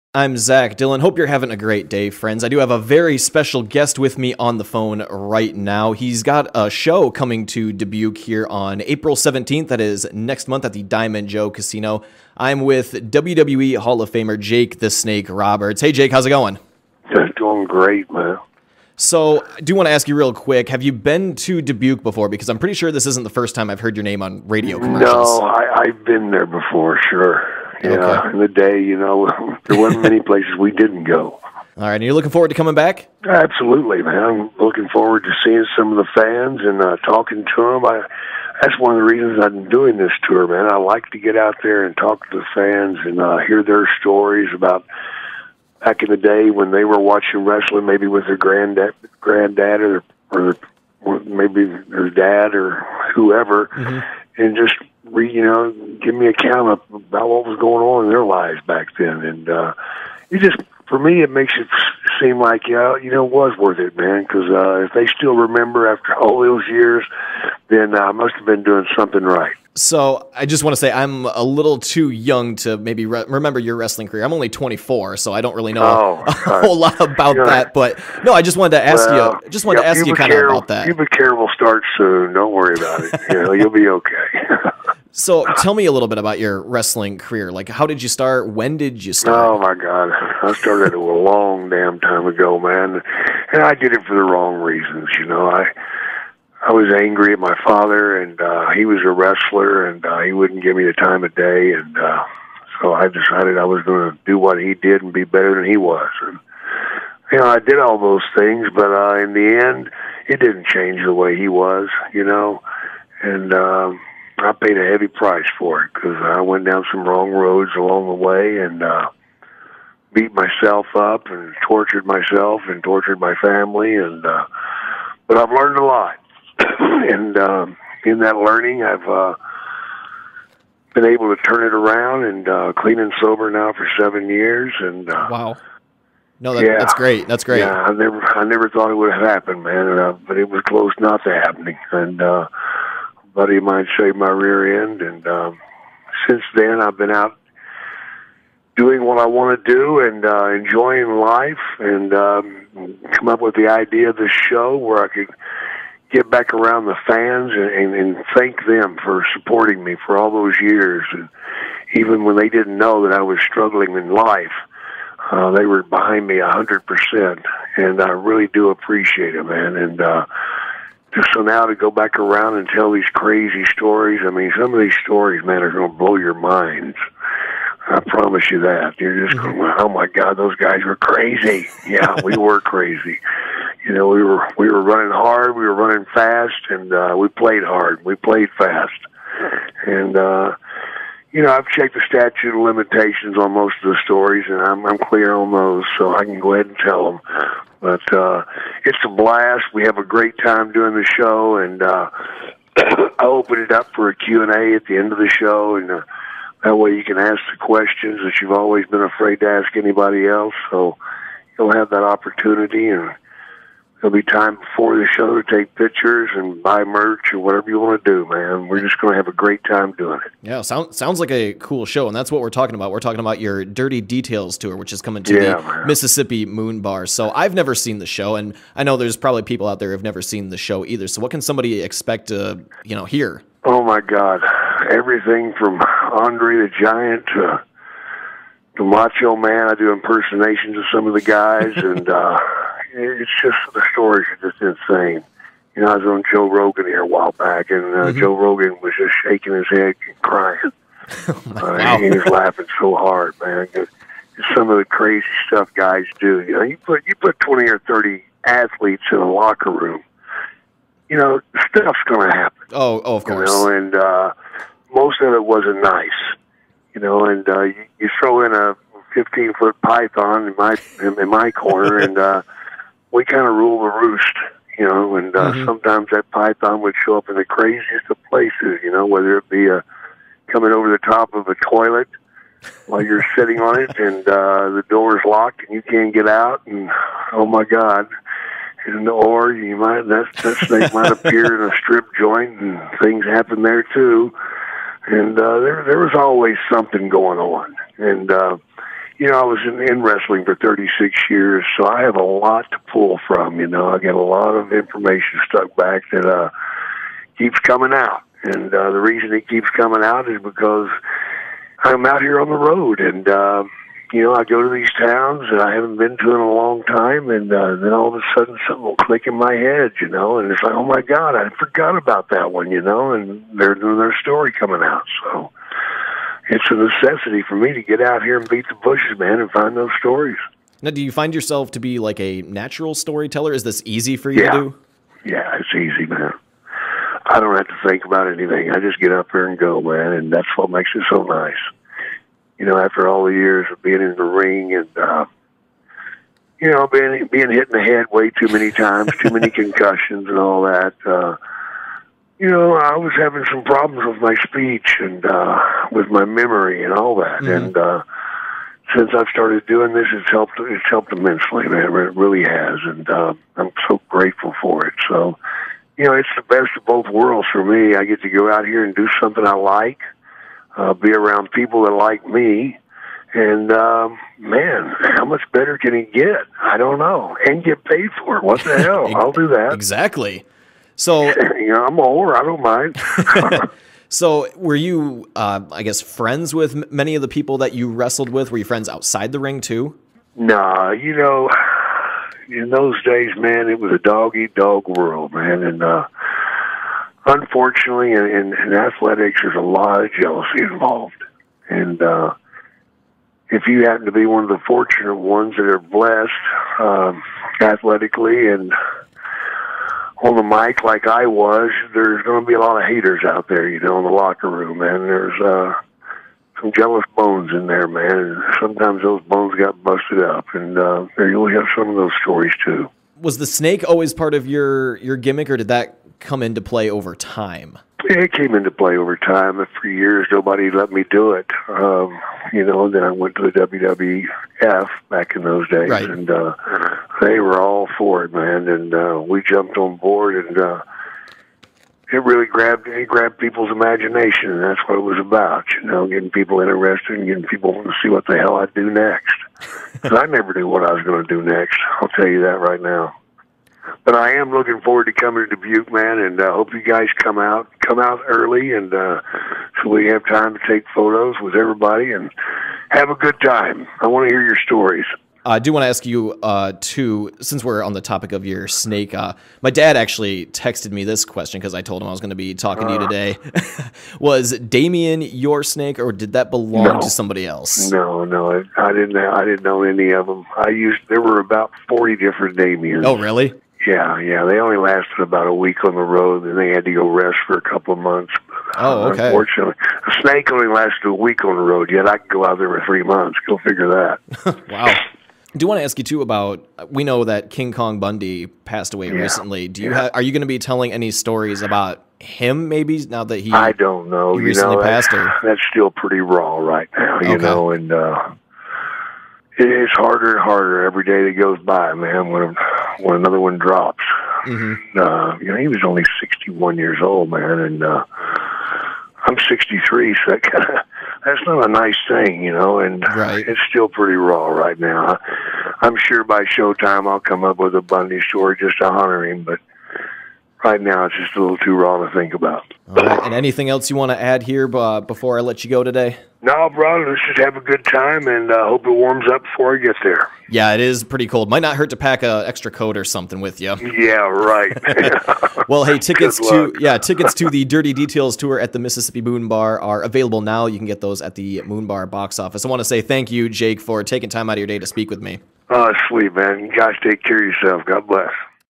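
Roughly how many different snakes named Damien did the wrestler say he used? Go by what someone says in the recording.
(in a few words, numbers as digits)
40.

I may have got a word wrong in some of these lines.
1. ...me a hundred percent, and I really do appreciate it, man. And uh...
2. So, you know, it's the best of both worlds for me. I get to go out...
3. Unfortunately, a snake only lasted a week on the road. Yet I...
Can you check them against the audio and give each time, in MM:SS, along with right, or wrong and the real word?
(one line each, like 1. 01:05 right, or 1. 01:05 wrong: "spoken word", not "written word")
1. 02:46 right
2. 06:05 right
3. 08:09 right.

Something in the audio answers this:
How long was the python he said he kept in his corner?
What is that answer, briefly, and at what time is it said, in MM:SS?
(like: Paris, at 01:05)
15 feet, at 04:29.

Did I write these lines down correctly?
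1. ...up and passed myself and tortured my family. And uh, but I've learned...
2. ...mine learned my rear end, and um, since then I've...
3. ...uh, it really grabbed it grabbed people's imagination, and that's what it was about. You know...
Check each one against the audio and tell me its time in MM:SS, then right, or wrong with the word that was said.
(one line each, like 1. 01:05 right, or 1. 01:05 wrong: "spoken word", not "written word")
1. 02:00 wrong: "tortured", not "passed"
2. 02:23 wrong: "saved", not "learned"
3. 07:20 right.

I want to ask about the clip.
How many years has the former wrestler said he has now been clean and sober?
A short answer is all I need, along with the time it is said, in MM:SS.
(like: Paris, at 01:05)
7, at 02:13.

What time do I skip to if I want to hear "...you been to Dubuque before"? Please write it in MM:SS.
00:20.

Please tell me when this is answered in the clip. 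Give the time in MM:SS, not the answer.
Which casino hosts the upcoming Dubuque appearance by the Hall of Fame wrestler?
00:10.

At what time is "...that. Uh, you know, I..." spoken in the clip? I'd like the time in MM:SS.
05:50.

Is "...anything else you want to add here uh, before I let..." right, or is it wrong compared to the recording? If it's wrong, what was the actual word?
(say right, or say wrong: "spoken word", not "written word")
right.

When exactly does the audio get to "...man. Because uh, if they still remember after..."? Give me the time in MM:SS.
01:03.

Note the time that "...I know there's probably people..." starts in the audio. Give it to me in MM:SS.
03:48.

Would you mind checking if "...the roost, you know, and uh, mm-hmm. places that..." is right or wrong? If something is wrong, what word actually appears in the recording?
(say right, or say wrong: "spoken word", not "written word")
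wrong: "sometimes", not "places".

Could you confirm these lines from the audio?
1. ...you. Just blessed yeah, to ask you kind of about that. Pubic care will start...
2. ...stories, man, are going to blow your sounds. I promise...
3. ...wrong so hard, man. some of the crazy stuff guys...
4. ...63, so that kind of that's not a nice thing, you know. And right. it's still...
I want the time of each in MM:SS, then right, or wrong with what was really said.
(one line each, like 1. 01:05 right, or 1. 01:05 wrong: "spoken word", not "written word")
1. 01:19 wrong: "wanted", not "blessed"
2. 02:55 wrong: "minds", not "sounds"
3. 04:12 wrong: "laughing", not "wrong"
4. 08:39 right.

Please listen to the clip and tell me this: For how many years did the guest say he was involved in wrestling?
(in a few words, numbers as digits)
36.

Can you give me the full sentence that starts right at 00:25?
No, I, I've been there before, sure.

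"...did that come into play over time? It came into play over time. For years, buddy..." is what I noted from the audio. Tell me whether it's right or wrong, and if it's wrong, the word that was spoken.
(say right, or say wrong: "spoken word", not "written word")
wrong: "nobody", not "buddy".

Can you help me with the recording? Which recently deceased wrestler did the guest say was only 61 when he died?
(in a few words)
King Kong Bundy.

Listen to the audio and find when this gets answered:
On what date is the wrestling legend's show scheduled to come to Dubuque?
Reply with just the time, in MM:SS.
00:08.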